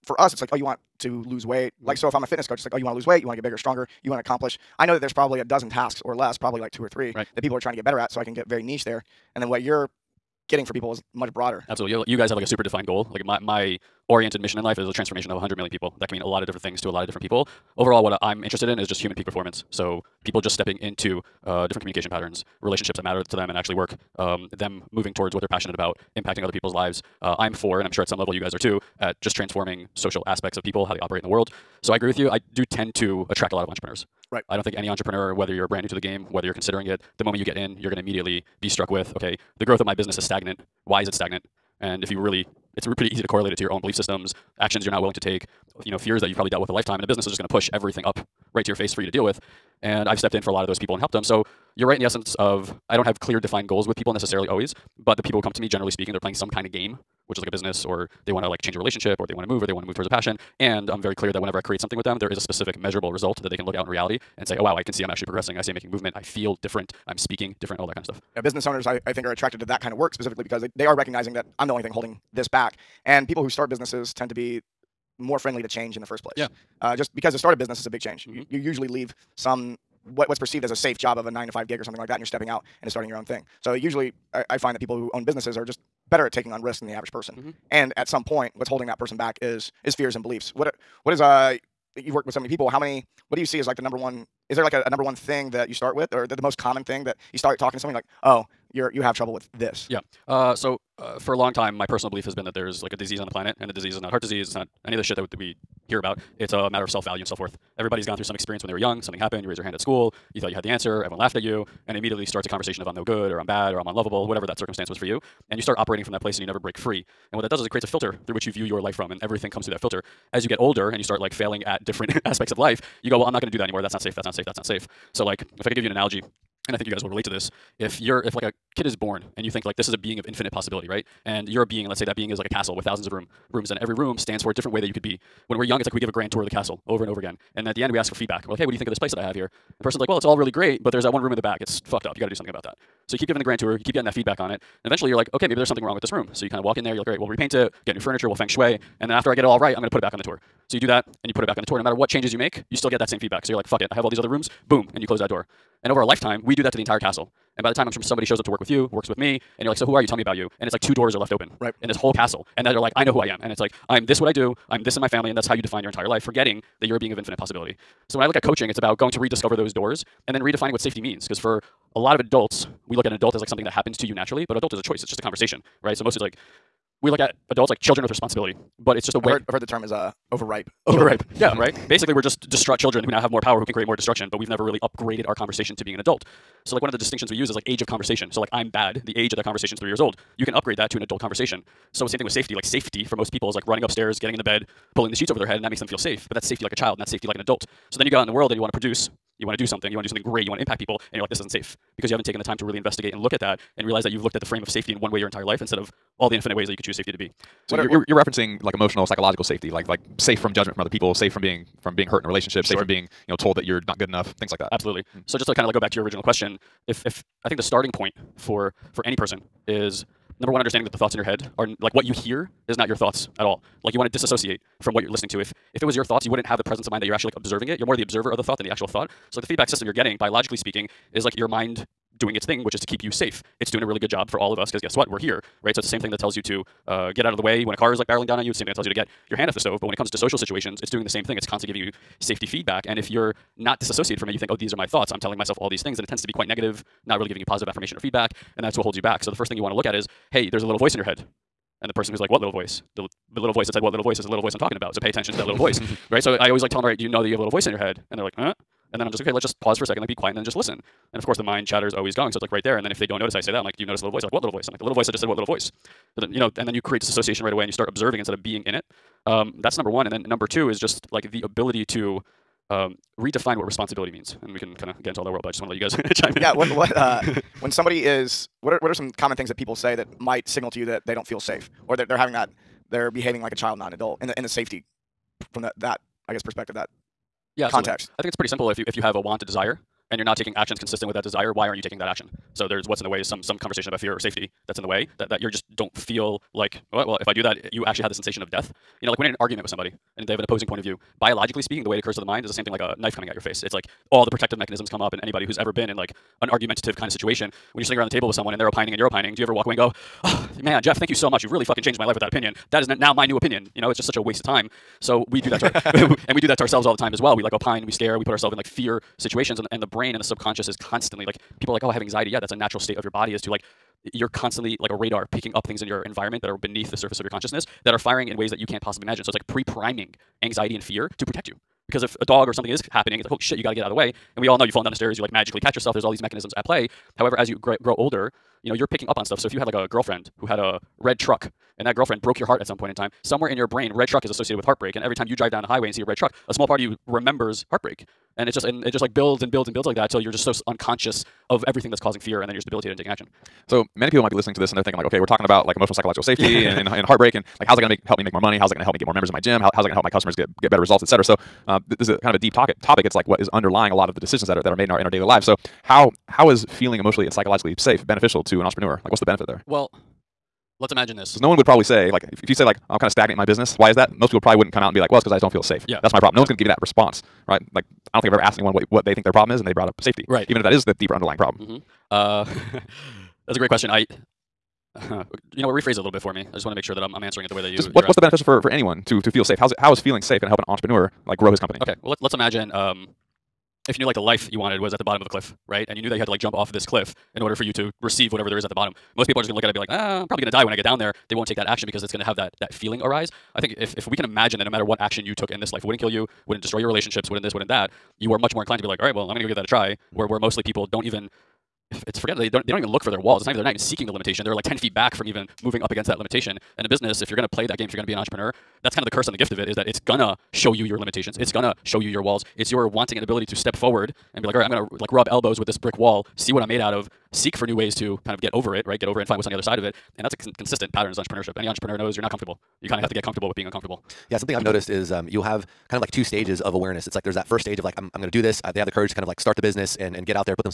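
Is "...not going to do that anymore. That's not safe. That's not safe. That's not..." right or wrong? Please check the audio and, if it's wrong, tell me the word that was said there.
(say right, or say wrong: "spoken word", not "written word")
right.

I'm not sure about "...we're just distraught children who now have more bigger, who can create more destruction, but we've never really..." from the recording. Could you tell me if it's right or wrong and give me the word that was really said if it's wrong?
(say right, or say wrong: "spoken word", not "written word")
wrong: "power", not "bigger".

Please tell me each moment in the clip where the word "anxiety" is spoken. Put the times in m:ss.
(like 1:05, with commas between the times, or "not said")
5:22, 5:30.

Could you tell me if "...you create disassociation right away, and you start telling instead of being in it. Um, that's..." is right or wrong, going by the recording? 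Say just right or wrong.
wrong.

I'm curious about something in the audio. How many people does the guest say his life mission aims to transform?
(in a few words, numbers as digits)
100 million.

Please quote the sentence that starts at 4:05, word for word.
I'm telling myself all these things.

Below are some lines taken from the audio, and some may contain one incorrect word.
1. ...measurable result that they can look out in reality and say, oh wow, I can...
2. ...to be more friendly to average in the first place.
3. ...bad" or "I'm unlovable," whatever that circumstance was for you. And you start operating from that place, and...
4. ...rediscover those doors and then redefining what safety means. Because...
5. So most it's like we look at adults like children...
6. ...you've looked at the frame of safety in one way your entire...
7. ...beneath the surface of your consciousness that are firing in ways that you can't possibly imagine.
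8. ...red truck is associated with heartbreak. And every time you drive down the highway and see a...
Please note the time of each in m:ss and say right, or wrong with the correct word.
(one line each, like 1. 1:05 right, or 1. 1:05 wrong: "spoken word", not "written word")
1. 1:02 right
2. 1:14 wrong: "change", not "average"
3. 1:53 right
4. 2:49 right
5. 2:55 right
6. 3:24 right
7. 5:26 right
8. 5:43 right.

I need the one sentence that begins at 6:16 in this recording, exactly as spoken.
one's going to give you that response, right?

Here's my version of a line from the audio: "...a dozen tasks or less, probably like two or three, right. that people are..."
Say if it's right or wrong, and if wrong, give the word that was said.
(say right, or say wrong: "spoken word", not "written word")
right.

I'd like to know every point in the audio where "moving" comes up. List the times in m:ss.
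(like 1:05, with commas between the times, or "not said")
0:24, 6:55.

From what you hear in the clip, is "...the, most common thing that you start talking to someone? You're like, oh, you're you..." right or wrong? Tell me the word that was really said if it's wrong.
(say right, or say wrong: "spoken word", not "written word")
right.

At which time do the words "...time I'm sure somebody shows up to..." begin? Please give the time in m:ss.
2:37.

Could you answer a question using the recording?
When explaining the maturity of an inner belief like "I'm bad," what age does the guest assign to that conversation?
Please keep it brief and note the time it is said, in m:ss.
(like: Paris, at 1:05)
3 years old, at 3:09.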